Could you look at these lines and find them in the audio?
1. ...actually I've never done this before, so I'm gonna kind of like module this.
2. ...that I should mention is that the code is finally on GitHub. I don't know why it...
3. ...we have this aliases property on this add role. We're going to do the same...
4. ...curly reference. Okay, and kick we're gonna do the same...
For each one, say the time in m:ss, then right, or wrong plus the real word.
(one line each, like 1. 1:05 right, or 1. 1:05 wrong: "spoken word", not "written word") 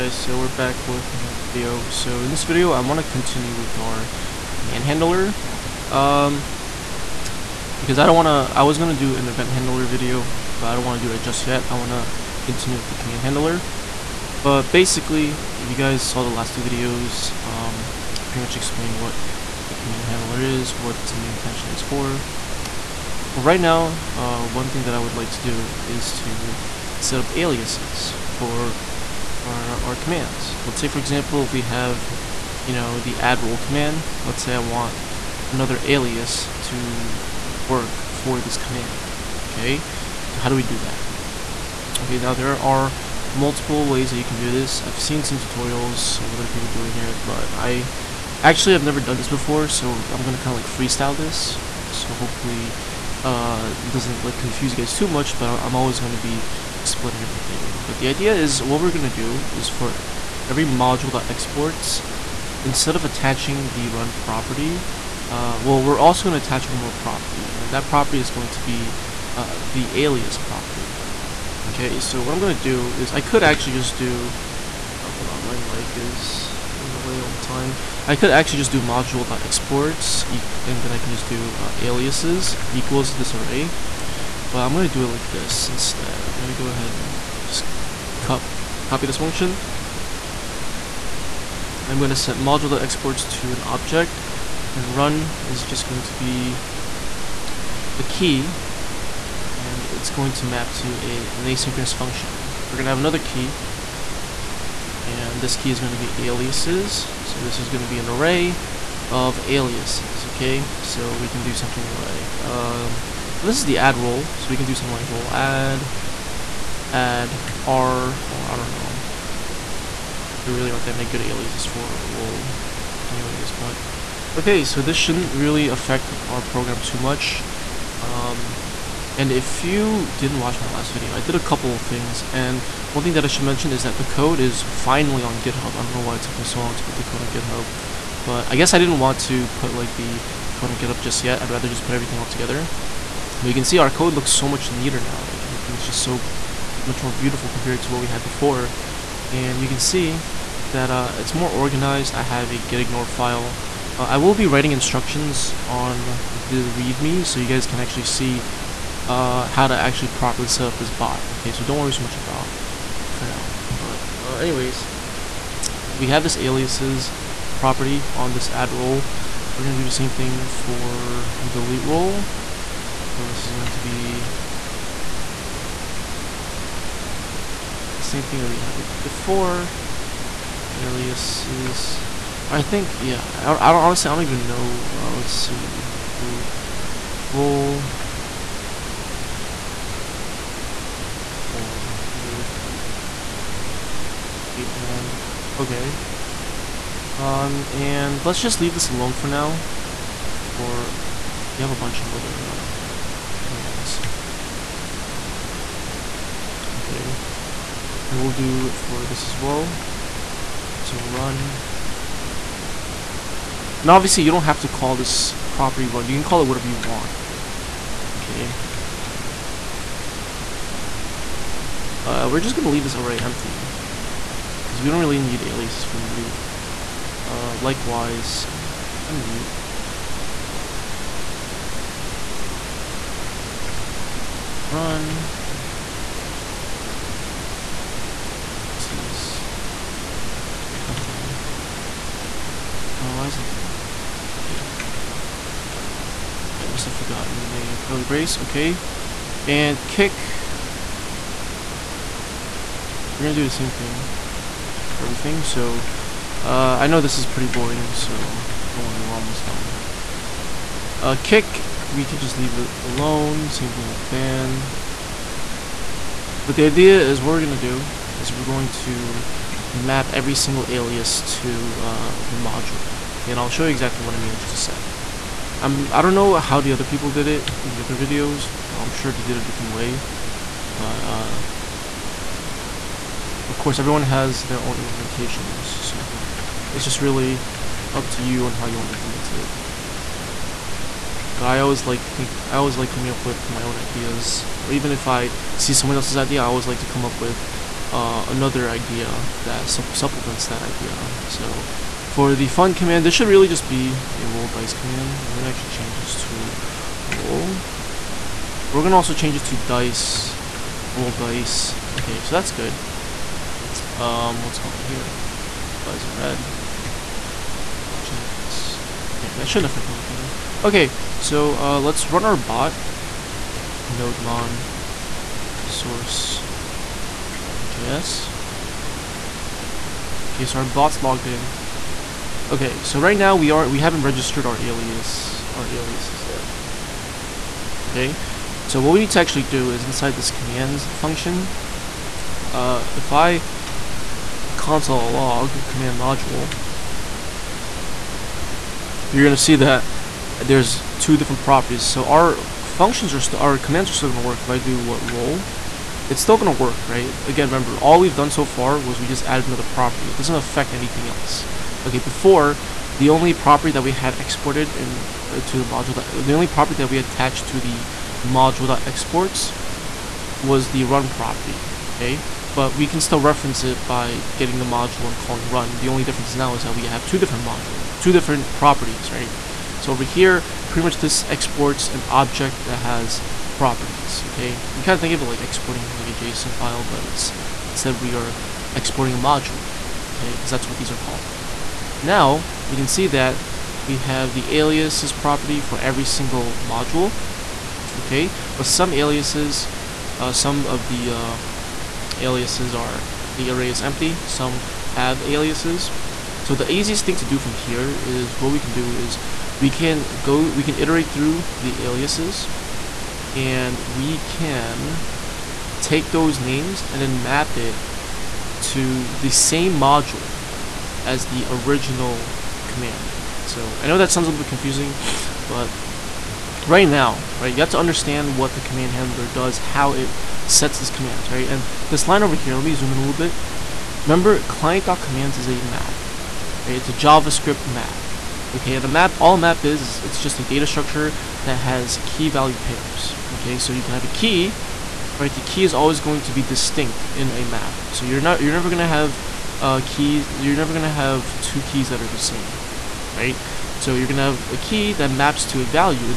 1. 0:48 wrong: "freestyle", not "module"
2. 2:13 right
3. 2:45 right
4. 4:07 wrong: "brace", not "reference".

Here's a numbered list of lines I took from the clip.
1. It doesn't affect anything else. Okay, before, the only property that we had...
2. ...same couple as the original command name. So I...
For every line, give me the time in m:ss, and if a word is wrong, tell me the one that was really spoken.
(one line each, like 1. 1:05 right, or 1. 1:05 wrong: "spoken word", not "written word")
1. 6:00 right
2. 6:59 wrong: "module", not "couple".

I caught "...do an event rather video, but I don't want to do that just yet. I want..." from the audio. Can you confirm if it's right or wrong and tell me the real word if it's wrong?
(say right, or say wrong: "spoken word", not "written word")
wrong: "handler", not "rather".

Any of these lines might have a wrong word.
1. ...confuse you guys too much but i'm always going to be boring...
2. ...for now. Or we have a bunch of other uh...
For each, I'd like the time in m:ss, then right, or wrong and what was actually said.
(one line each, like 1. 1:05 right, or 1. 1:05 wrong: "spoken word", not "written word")
1. 0:54 wrong: "splitting", not "boring"
2. 3:19 right.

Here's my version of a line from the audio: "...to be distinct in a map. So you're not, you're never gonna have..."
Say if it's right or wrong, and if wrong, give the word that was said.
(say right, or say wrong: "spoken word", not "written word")
right.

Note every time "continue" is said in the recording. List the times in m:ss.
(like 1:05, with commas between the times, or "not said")
0:03, 0:12.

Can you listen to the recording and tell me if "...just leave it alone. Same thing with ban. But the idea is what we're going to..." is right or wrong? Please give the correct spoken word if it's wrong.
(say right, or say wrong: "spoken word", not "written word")
right.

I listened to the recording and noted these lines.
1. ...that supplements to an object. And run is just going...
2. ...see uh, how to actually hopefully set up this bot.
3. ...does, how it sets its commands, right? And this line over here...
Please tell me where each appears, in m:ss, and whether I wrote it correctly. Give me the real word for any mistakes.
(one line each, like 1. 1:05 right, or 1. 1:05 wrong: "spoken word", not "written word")
1. 1:32 wrong: "exports", not "supplements"
2. 2:38 wrong: "properly", not "hopefully"
3. 7:09 right.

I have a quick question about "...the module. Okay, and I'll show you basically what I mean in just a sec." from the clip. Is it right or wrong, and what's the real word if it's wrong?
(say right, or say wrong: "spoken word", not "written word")
wrong: "exactly", not "basically".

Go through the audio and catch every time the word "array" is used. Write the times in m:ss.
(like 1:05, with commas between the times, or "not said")
1:23, 1:48, 3:42, 6:43.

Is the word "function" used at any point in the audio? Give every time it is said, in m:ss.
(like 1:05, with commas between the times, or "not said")
1:29, 1:41, 5:40, 5:52.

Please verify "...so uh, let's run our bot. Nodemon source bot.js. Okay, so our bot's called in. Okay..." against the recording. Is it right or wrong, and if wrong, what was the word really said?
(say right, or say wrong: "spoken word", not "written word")
wrong: "logged", not "called".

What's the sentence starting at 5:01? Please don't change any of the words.
So for the fun command, this should really just be a roll dice command.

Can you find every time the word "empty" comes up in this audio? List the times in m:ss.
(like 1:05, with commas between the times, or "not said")
3:43, 6:43.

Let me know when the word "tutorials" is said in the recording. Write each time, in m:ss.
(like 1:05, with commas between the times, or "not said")
0:45.